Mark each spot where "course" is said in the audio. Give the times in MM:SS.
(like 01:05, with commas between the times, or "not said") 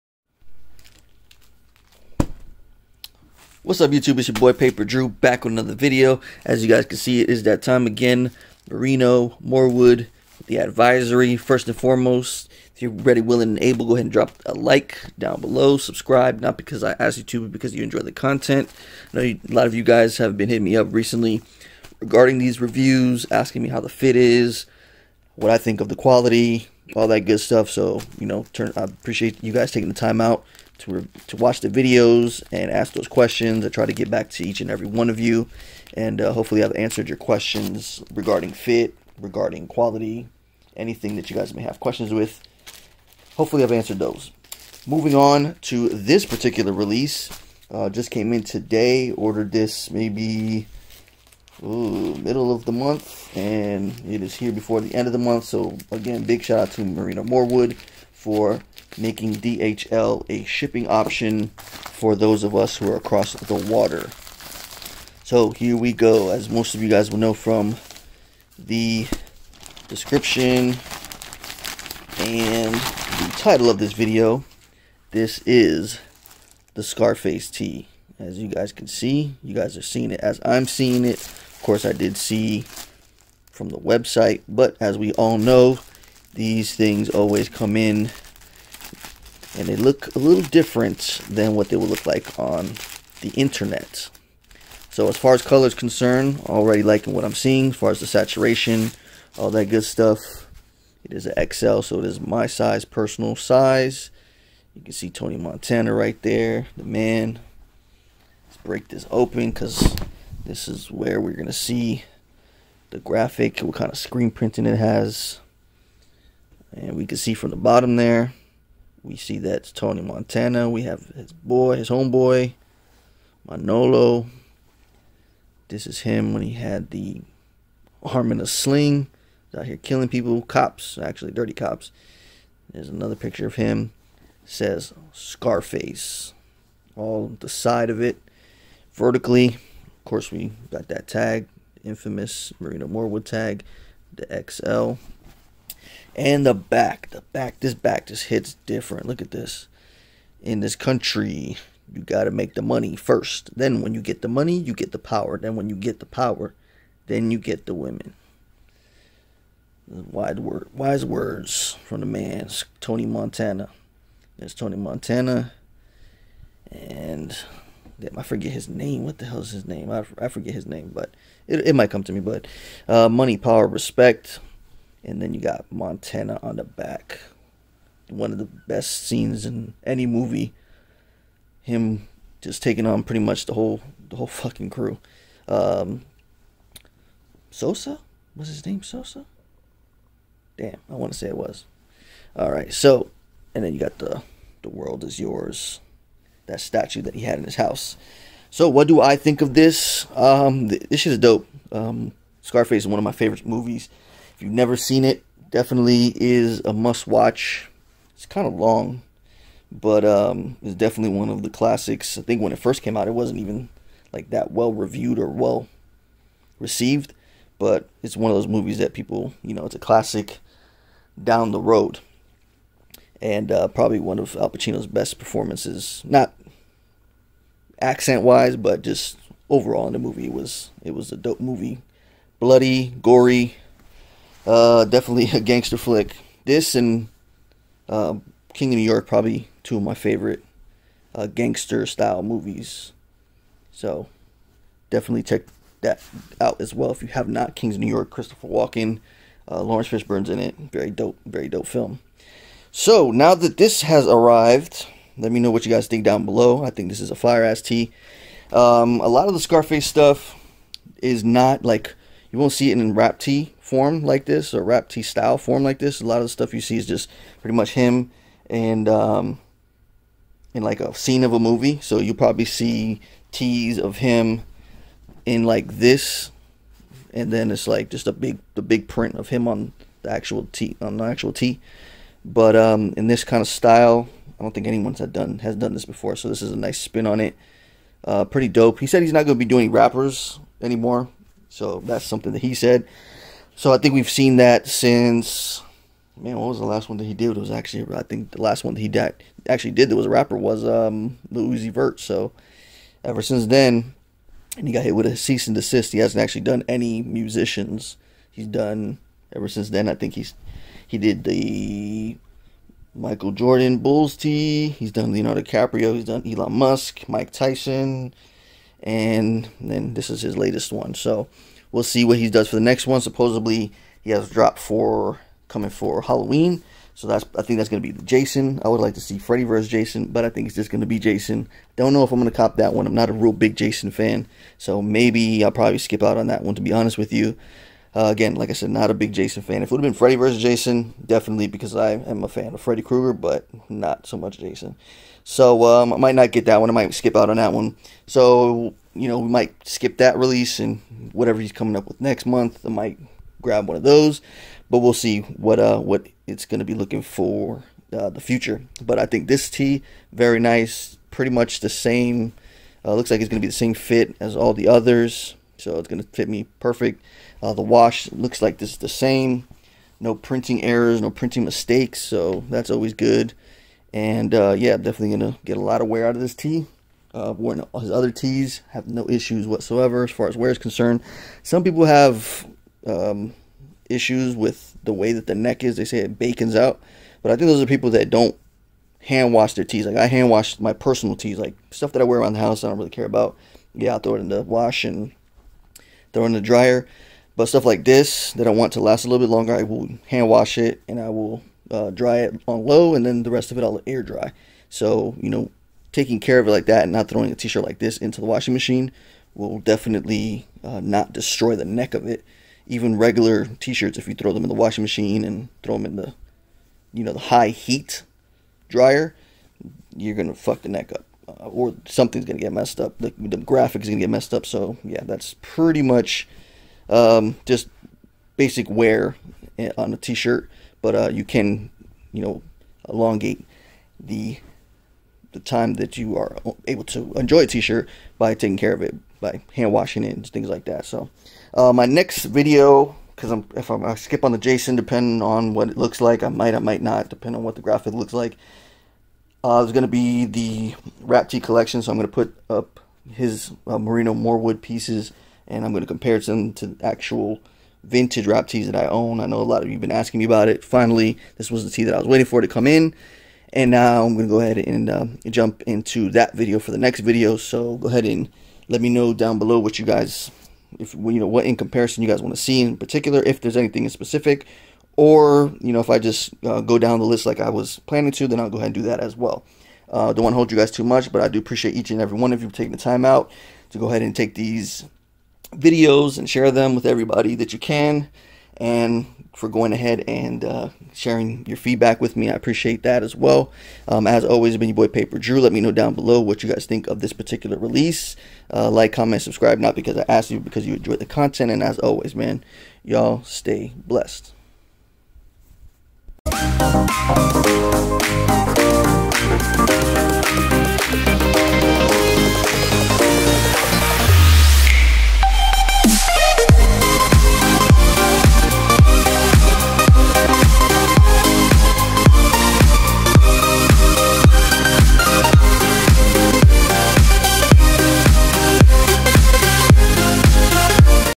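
01:21, 02:20.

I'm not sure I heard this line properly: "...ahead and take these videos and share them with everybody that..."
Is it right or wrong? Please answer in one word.
right.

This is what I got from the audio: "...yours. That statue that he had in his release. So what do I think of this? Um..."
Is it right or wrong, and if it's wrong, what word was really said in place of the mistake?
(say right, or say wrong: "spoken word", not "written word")
wrong: "house", not "release".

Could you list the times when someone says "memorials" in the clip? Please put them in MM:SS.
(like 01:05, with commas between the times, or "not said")
not said.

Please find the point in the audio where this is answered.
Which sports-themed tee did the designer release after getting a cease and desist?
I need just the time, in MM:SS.
05:12.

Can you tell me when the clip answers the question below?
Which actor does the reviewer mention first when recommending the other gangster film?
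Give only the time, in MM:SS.
04:08.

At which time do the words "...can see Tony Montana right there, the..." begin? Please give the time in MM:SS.
01:44.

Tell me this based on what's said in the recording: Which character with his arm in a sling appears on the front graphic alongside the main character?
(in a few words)
Manolo.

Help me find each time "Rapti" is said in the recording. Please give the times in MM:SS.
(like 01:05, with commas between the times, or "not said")
07:31, 07:38.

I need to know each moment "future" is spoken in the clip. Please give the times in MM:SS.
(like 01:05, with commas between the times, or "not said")
05:58.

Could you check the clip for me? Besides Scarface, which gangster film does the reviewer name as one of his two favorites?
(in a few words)
King of New York.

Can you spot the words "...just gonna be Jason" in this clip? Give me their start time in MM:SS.
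05:30.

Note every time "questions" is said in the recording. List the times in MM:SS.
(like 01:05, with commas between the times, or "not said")
00:33, 00:37, 00:41.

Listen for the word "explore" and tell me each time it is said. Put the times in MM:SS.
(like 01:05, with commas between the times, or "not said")
not said.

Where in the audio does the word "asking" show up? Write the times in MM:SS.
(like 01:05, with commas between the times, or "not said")
00:23, 07:39.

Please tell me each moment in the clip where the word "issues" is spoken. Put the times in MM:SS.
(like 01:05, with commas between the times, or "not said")
06:19, 06:23.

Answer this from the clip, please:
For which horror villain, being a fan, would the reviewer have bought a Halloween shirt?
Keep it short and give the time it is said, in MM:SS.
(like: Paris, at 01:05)
Freddy Krueger, at 05:42.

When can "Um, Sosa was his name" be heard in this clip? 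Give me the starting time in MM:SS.
03:05.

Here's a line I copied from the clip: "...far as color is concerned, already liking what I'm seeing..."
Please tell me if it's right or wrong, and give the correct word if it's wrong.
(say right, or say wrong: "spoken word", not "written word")
right.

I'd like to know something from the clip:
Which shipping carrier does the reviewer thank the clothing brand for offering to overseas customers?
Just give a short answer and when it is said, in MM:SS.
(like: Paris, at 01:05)
DHL, at 00:59.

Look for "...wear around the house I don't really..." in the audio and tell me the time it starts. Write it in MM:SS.
06:32.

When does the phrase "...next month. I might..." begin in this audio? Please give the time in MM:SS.
05:51.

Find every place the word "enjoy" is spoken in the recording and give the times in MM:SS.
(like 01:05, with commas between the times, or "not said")
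00:17, 07:17, 08:20.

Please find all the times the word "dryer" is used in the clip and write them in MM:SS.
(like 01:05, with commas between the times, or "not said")
06:36, 06:58.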